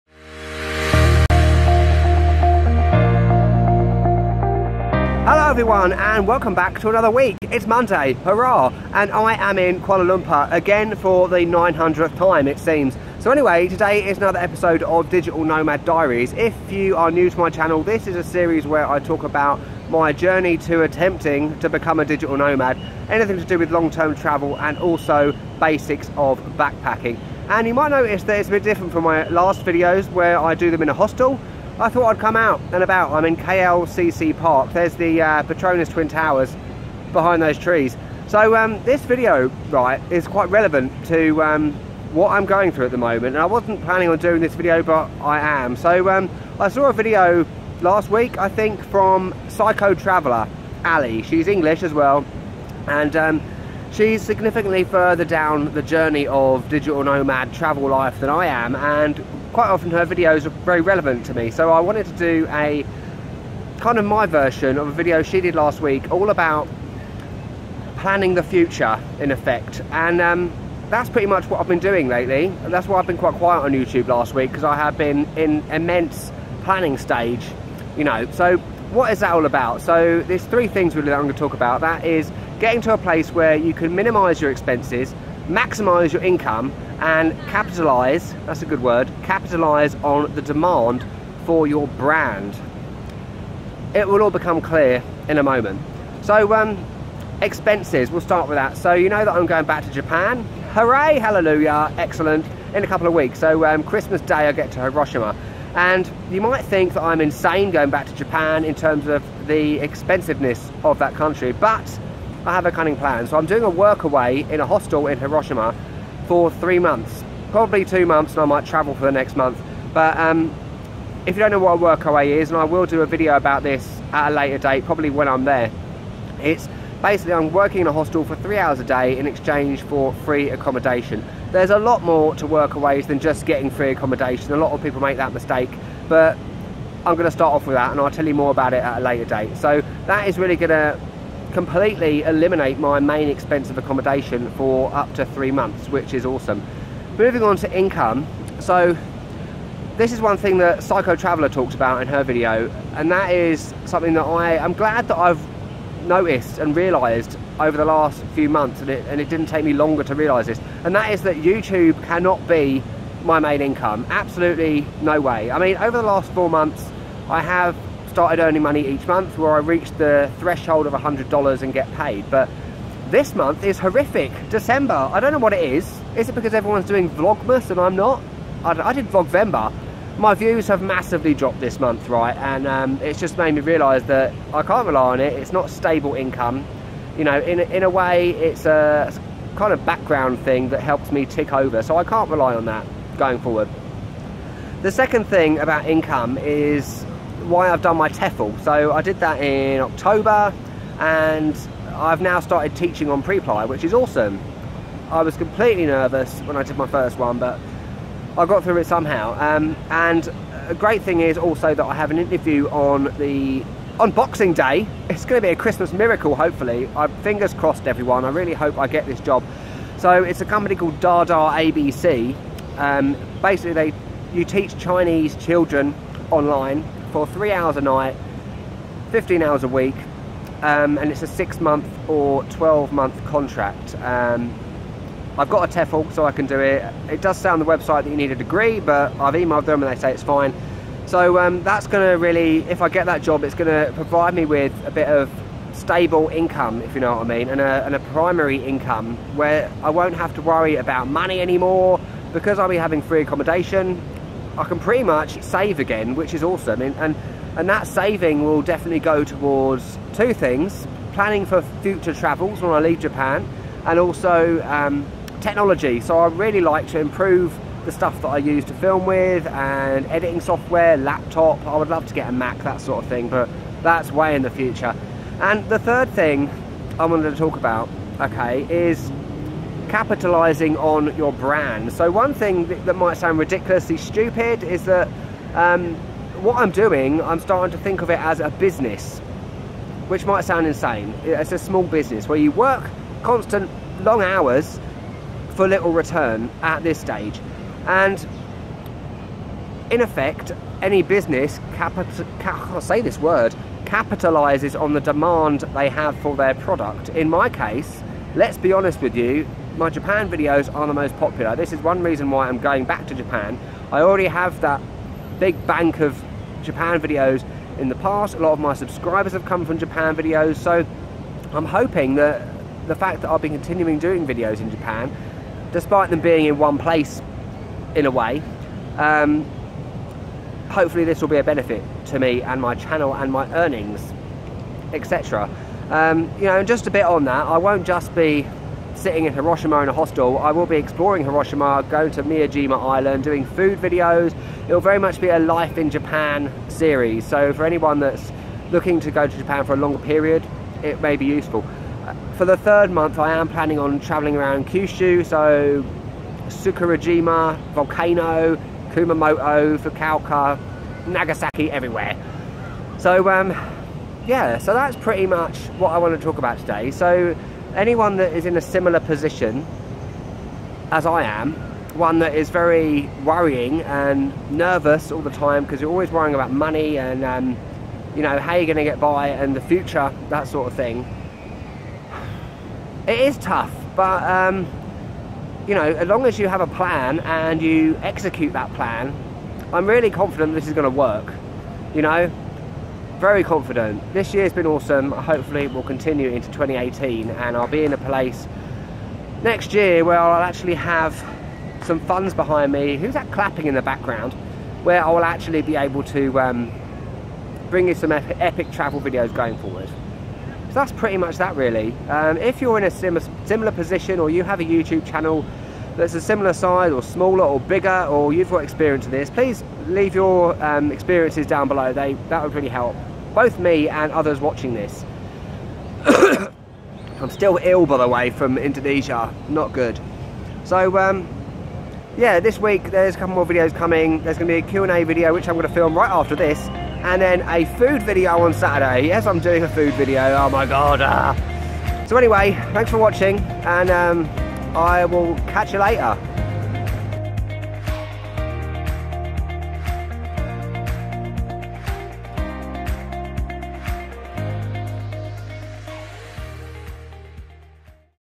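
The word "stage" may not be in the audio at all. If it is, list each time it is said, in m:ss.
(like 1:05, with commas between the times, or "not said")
1:16, 4:56.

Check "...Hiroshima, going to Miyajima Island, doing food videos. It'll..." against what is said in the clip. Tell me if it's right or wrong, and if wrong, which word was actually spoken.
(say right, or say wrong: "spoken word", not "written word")
right.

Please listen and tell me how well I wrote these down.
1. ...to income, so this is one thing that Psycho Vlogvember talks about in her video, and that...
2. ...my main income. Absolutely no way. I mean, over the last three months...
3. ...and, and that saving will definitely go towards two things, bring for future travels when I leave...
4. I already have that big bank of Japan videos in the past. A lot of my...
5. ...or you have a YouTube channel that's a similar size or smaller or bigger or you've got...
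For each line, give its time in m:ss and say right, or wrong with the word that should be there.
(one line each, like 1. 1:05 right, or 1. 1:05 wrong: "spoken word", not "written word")
1. 2:27 wrong: "Traveller", not "Vlogvember"
2. 2:43 wrong: "four", not "three"
3. 4:16 wrong: "planning", not "bring"
4. 5:13 right
5. 6:54 right.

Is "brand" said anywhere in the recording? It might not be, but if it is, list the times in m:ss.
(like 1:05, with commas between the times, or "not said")
1:31, 4:41.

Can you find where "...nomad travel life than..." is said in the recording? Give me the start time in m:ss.
0:57.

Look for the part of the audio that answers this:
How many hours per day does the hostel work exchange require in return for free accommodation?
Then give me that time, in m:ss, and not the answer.
2:08.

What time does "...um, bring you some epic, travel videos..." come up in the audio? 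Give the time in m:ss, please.
6:46.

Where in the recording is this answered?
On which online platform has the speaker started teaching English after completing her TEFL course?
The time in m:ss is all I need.
3:23.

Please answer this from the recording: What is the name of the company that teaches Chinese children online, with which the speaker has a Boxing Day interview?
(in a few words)
Dada ABC.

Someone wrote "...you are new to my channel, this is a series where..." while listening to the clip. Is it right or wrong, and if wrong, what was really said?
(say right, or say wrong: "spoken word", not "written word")
right.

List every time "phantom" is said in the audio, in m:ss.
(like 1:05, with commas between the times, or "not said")
not said.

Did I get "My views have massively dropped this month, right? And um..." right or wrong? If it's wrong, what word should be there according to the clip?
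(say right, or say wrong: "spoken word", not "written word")
right.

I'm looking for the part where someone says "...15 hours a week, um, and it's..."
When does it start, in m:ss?
3:49.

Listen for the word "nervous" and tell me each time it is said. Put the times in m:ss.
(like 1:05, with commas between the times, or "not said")
3:25, 6:14.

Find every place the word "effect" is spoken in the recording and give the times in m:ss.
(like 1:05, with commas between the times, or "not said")
1:09, 4:59.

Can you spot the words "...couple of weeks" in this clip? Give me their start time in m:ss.
1:42.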